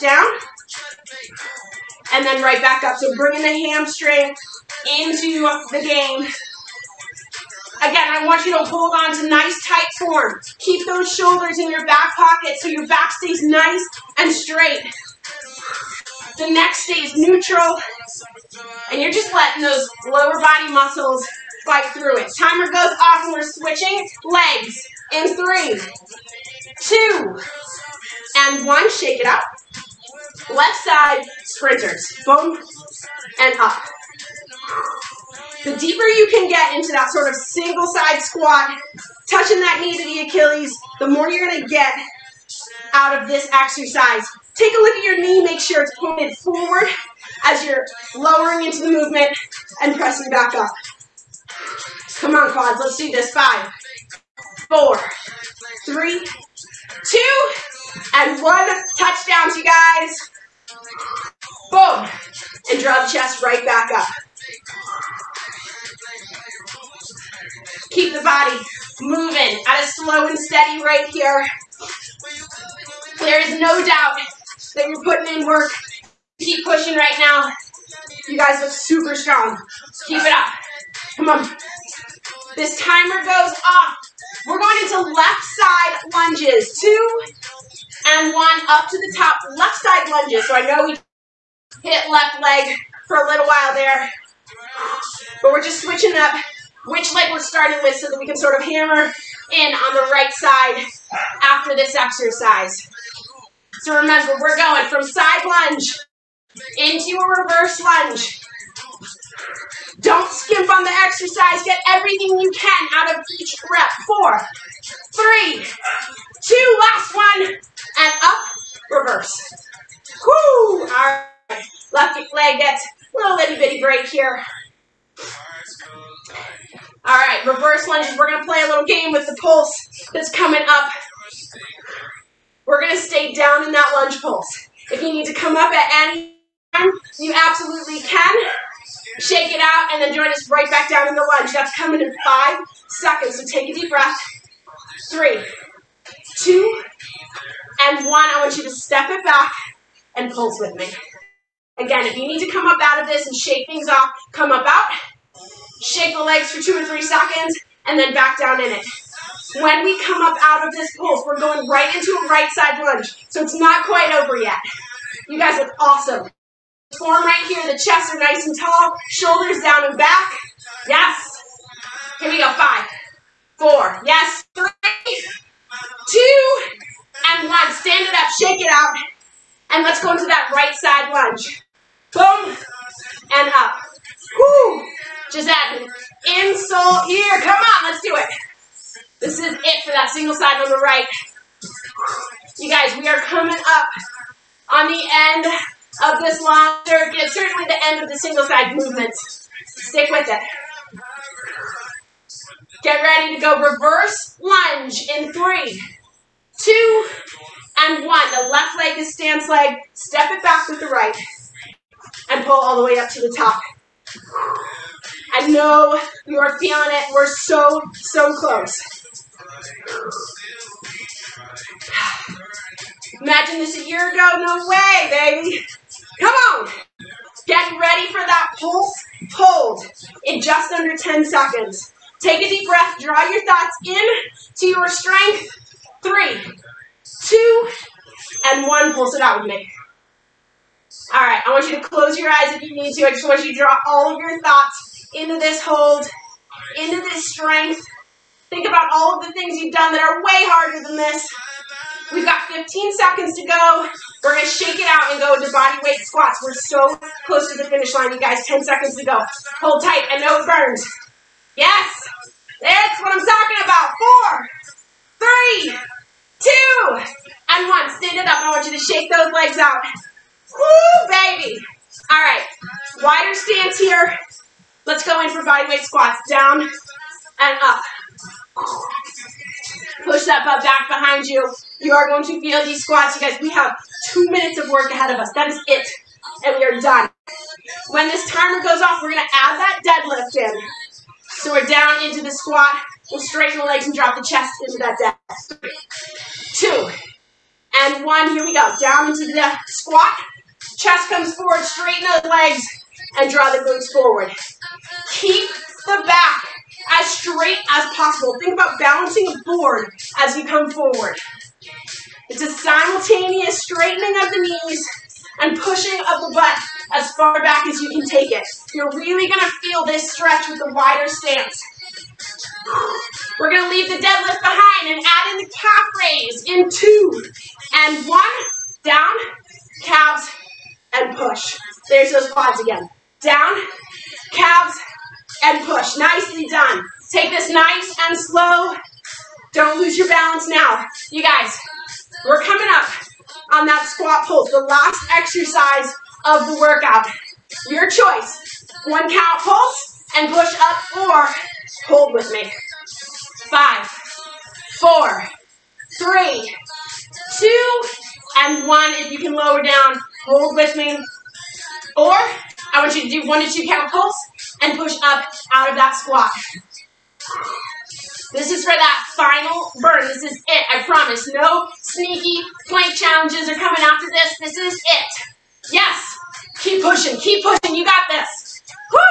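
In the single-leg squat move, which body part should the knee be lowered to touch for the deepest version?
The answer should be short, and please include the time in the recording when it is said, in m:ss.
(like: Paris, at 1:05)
Achilles, at 0:40.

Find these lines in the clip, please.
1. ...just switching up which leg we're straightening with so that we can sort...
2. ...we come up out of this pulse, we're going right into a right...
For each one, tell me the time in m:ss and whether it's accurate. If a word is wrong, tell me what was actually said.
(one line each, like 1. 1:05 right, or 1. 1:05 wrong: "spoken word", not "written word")
1. 1:35 wrong: "starting", not "straightening"
2. 2:39 right.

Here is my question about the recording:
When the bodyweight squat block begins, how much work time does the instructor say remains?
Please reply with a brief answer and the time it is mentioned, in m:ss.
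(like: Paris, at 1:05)
2 minutes, at 4:44.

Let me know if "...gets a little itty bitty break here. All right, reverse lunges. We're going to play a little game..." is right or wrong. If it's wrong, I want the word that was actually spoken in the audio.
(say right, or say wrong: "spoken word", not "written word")
right.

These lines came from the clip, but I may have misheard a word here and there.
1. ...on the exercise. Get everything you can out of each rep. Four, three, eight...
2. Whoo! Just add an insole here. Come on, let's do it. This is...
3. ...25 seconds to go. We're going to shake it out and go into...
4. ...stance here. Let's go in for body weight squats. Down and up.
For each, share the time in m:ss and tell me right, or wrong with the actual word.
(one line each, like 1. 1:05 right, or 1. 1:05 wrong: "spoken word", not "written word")
1. 1:50 wrong: "two", not "eight"
2. 3:04 right
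3. 4:12 wrong: "15", not "25"
4. 4:33 right.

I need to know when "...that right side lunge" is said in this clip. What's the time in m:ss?
3:00.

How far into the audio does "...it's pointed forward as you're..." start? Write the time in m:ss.
0:45.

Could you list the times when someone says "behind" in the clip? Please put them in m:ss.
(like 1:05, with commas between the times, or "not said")
4:40, 5:24.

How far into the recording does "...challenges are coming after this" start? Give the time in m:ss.
6:12.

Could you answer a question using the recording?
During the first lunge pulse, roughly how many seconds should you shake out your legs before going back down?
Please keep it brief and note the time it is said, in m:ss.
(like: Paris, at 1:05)
2 or 3 seconds, at 2:36.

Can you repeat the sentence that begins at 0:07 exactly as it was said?
Again, I want you to hold on to nice tight form.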